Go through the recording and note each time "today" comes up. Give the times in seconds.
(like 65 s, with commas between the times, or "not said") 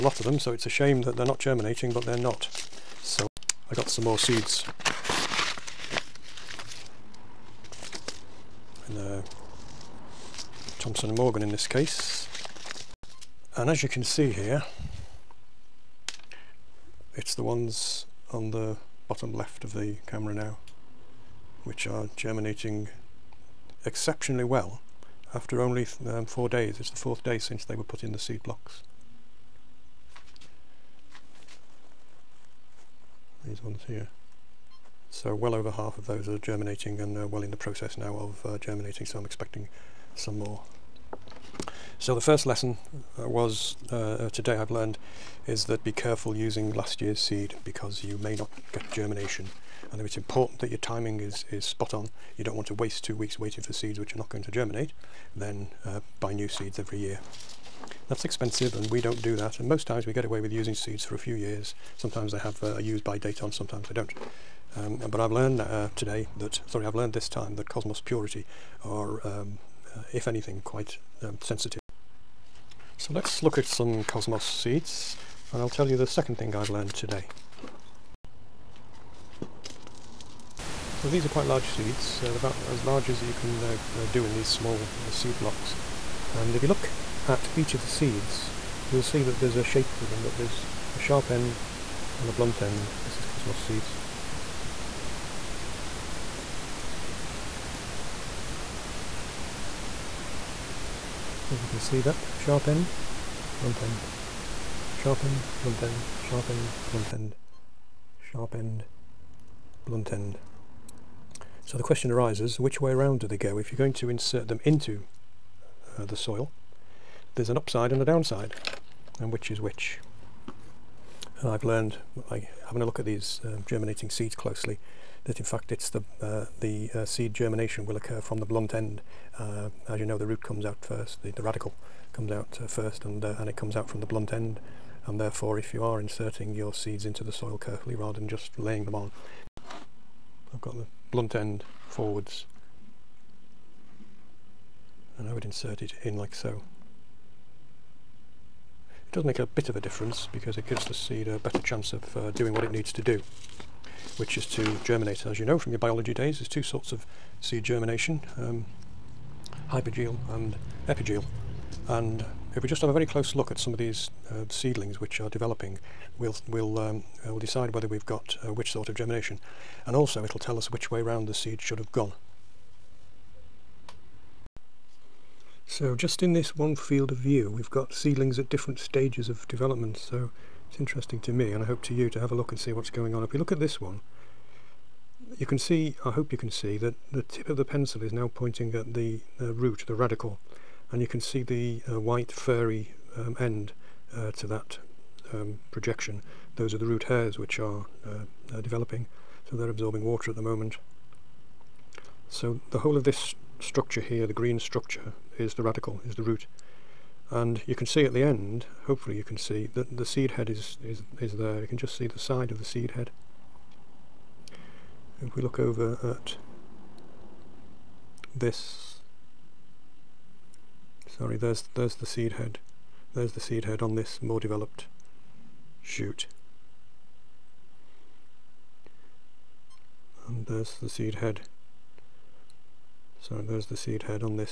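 44 s, 65 s, 76 s.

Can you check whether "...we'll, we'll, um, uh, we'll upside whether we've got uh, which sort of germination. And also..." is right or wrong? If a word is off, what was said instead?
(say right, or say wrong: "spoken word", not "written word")
wrong: "decide", not "upside".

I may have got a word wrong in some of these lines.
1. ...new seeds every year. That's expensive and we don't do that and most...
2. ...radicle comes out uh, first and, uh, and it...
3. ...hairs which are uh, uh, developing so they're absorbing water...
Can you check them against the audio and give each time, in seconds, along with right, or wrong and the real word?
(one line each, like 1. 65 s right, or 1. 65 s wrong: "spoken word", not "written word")
1. 56 s right
2. 131 s right
3. 197 s right.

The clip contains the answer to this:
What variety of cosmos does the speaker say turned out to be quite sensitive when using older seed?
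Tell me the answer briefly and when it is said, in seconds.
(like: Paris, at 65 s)
Cosmos Purity, at 67 s.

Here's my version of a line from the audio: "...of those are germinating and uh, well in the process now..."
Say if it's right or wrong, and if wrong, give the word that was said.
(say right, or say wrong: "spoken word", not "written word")
right.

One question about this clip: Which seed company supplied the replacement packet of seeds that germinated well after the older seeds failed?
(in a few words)
Thompson and Morgan.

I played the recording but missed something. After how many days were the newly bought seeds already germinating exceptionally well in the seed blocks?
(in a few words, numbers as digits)
4.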